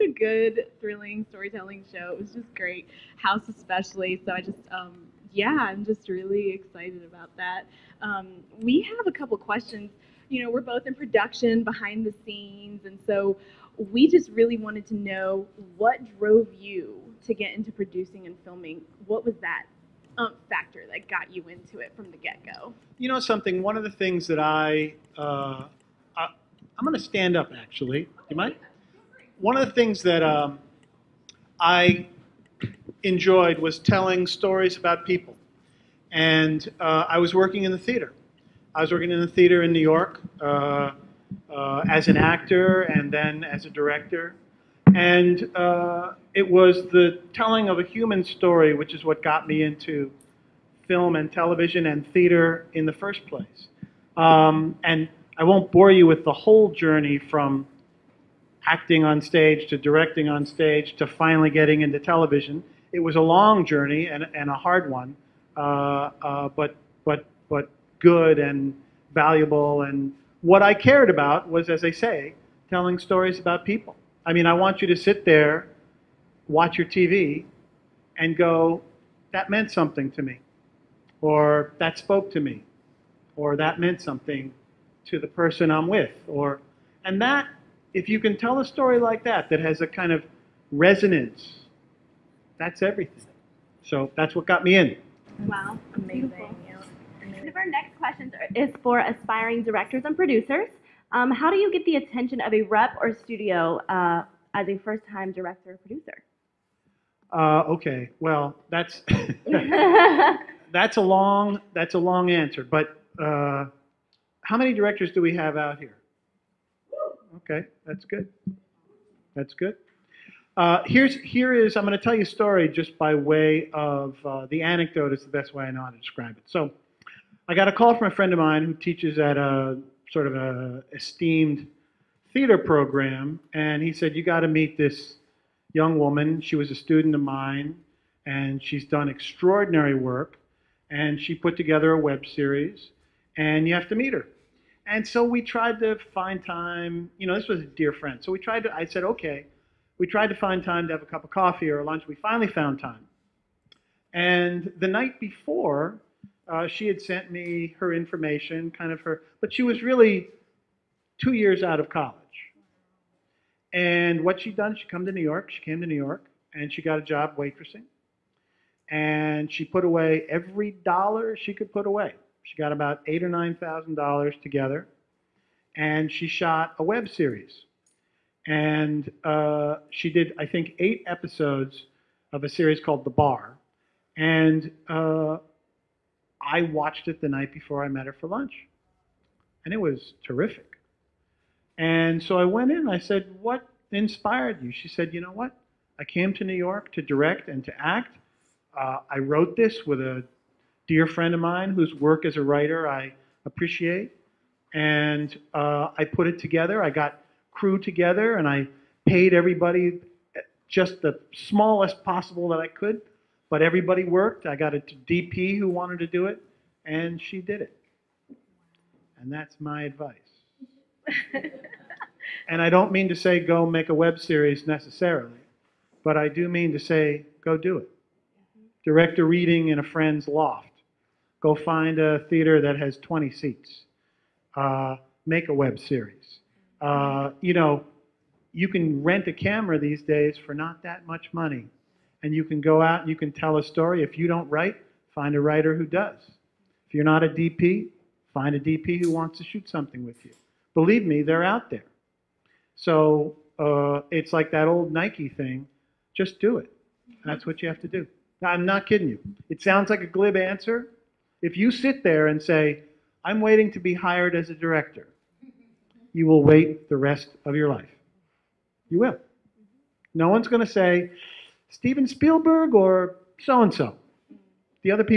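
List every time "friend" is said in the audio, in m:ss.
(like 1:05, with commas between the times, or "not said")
2:08, 2:27, 3:21, 3:49.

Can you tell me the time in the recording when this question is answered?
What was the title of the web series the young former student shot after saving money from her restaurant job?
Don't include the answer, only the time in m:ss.
3:03.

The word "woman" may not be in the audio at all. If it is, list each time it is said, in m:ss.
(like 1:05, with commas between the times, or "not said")
2:15.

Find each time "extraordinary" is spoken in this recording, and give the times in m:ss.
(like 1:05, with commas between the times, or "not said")
2:19.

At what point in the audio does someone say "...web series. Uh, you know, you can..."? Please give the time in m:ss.
3:55.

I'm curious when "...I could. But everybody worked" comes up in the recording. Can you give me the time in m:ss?
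3:32.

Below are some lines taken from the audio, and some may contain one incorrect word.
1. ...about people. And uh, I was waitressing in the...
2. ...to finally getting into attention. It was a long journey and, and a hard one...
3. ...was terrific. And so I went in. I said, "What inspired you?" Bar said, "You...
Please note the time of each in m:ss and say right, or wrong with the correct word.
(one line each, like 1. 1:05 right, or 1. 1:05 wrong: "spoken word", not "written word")
1. 0:34 wrong: "working", not "waitressing"
2. 1:00 wrong: "television", not "attention"
3. 3:09 wrong: "She", not "Bar".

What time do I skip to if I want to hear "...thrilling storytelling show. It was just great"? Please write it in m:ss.
0:00.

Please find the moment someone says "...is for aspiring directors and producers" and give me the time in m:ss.
1:38.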